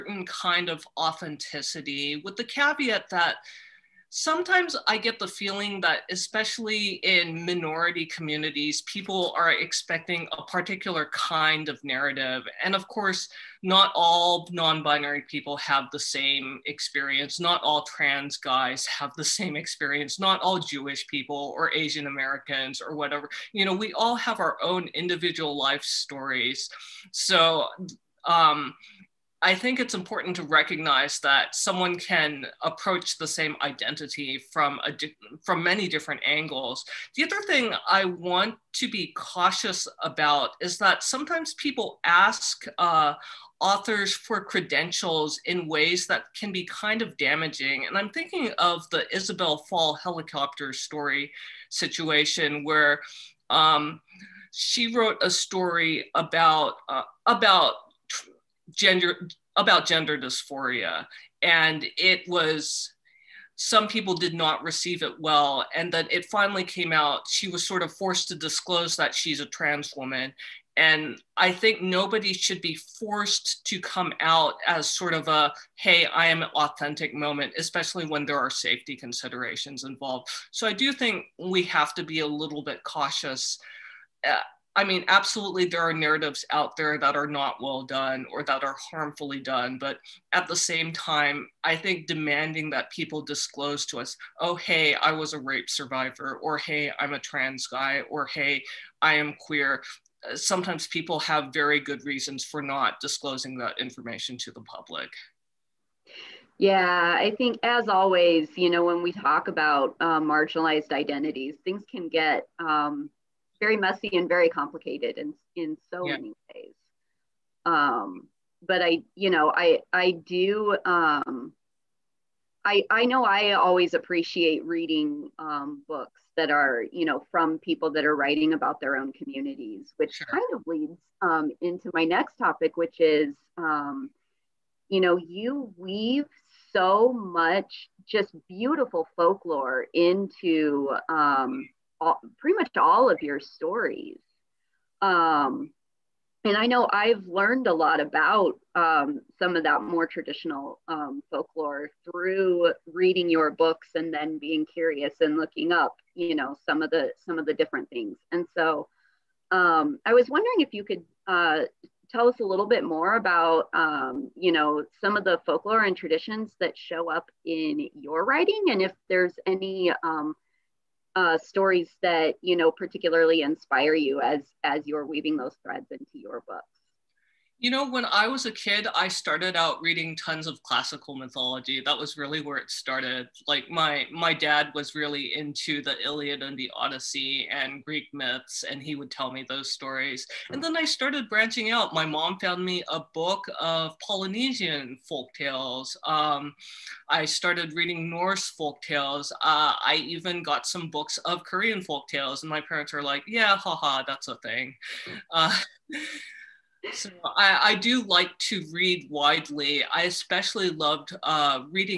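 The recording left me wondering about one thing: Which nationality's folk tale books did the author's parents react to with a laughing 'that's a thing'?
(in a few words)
Korean.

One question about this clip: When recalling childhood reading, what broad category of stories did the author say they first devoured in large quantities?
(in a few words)
classical mythology.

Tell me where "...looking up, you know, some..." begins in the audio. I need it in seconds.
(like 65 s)
155 s.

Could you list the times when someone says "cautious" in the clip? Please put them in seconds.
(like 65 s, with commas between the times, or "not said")
39 s, 82 s.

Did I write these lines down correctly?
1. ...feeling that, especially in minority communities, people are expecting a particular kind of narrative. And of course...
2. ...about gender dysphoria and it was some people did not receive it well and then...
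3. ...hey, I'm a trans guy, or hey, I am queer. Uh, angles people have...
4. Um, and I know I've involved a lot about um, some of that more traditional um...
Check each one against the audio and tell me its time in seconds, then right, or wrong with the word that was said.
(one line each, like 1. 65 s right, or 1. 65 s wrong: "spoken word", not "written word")
1. 5 s right
2. 59 s right
3. 96 s wrong: "sometimes", not "angles"
4. 145 s wrong: "learned", not "involved".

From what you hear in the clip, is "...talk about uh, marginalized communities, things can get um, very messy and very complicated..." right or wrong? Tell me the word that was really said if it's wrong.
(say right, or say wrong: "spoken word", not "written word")
wrong: "identities", not "communities".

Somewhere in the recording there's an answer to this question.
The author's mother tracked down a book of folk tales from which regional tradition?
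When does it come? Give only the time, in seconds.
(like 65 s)
194 s.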